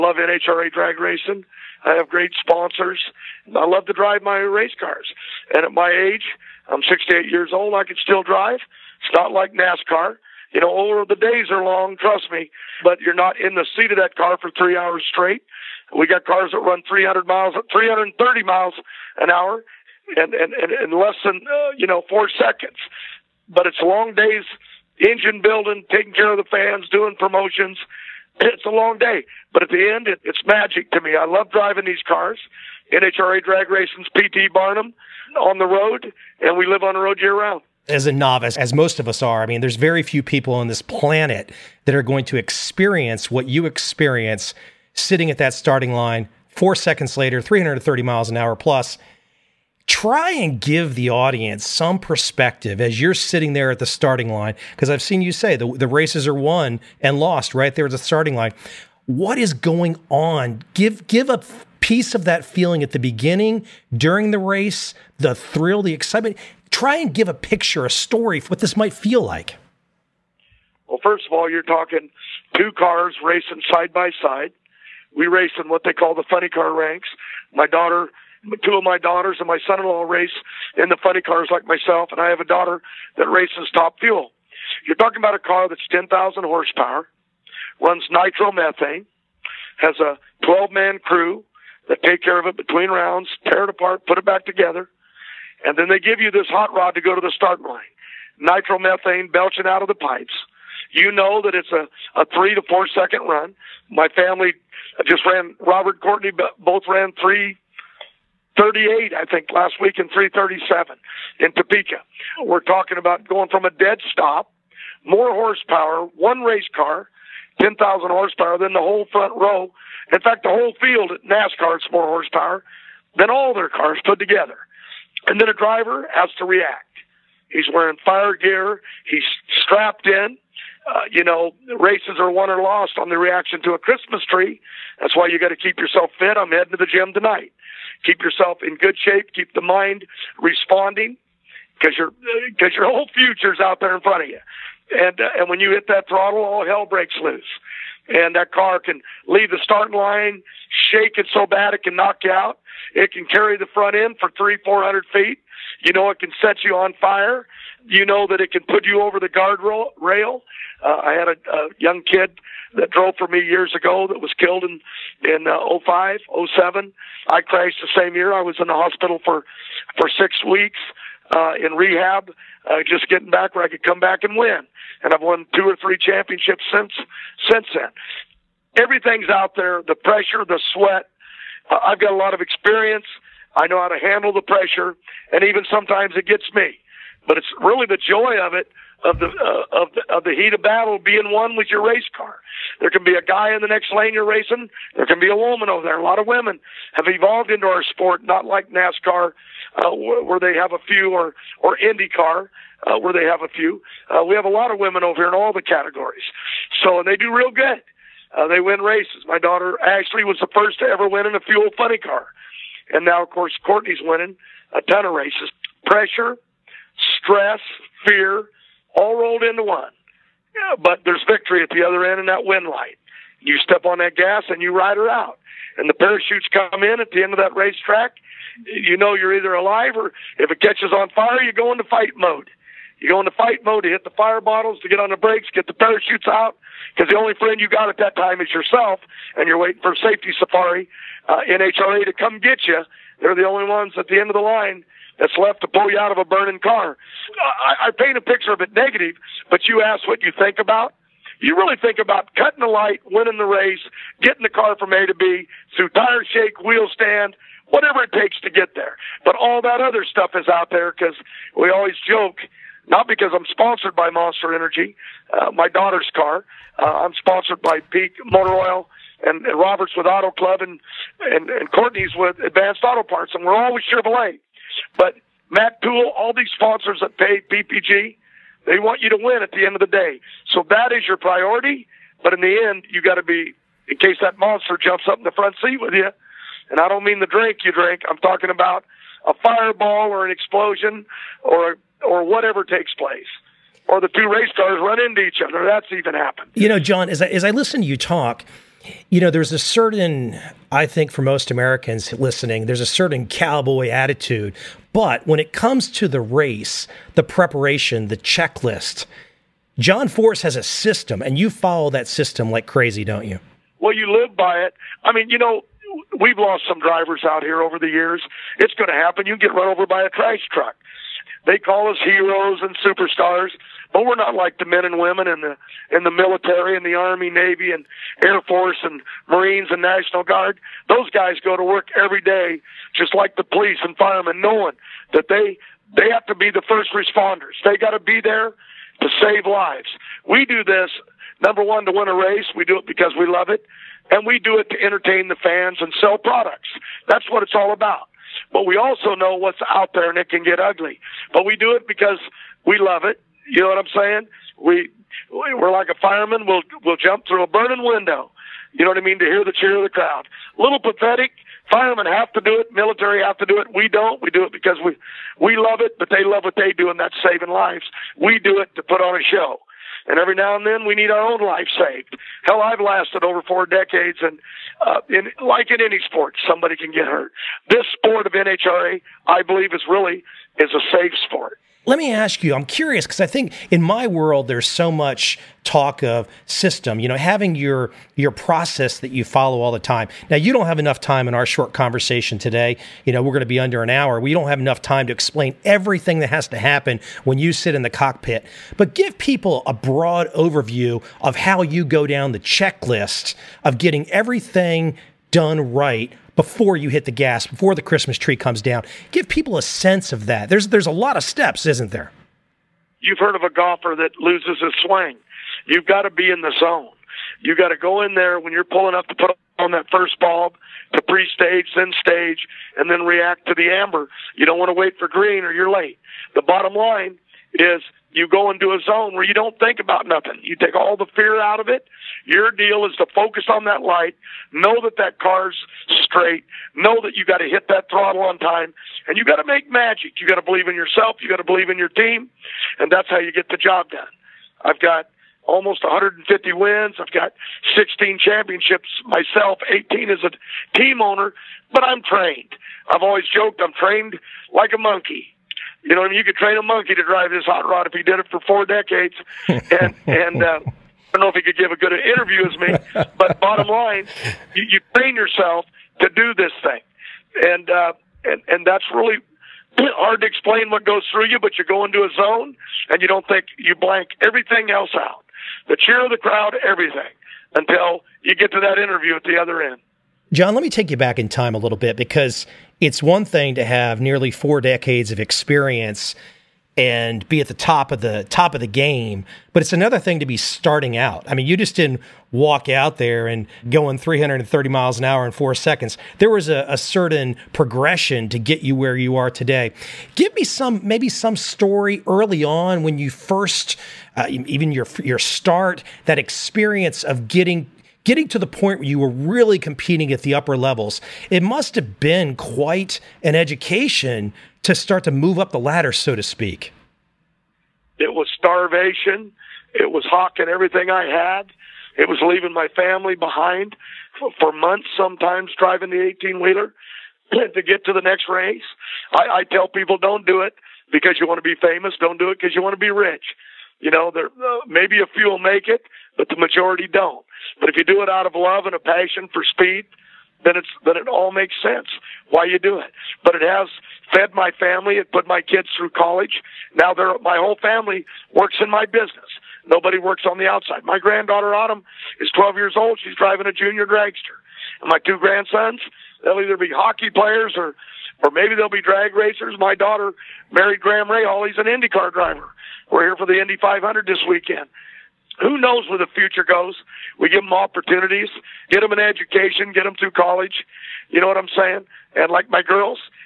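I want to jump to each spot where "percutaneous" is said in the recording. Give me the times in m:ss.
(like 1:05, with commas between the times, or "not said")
not said.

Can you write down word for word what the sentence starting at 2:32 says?
It can carry the front end for three, four hundred feet.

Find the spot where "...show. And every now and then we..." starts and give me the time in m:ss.
6:09.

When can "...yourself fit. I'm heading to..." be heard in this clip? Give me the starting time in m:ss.
2:15.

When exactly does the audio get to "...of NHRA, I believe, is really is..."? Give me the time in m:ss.
6:18.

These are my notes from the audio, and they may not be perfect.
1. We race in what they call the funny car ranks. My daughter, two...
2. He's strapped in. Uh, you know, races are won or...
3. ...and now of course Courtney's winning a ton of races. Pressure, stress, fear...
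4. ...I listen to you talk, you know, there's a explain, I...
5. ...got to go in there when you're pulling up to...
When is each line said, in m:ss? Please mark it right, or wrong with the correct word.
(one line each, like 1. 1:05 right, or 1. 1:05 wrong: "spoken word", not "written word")
1. 1:15 right
2. 2:09 right
3. 3:32 right
4. 4:57 wrong: "certain", not "explain"
5. 6:57 right.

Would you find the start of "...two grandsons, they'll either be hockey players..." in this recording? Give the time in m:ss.
9:14.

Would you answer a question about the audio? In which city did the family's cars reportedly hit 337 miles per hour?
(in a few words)
Topeka.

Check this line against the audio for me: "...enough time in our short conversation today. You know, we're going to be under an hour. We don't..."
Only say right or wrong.
right.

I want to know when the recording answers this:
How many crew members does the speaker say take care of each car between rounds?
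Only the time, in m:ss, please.
1:30.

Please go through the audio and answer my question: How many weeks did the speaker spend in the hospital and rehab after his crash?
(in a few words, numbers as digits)
6.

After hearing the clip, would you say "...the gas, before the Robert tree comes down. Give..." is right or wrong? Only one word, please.
wrong.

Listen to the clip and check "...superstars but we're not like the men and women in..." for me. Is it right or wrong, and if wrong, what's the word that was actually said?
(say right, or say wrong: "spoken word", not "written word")
right.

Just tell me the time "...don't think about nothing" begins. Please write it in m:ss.
7:09.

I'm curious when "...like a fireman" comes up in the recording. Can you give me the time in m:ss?
5:55.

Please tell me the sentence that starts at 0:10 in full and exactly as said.
You know, or the days are long, trust me, but you're not in the seat of that car for three hours straight.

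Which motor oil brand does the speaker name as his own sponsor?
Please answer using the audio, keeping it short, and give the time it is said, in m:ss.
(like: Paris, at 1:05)
Peak Motor Oil, at 4:27.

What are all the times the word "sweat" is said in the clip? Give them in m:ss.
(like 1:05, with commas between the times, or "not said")
3:00.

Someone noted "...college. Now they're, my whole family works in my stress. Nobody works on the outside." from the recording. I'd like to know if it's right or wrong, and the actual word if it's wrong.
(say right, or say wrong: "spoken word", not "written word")
wrong: "business", not "stress".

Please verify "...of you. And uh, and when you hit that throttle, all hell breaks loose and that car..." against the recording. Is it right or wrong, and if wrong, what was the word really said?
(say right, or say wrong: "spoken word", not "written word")
right.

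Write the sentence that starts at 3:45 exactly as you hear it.
And the parachutes come in at the end of that racetrack.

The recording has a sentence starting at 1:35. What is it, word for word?
And then they give you this hot rod to go to the start line.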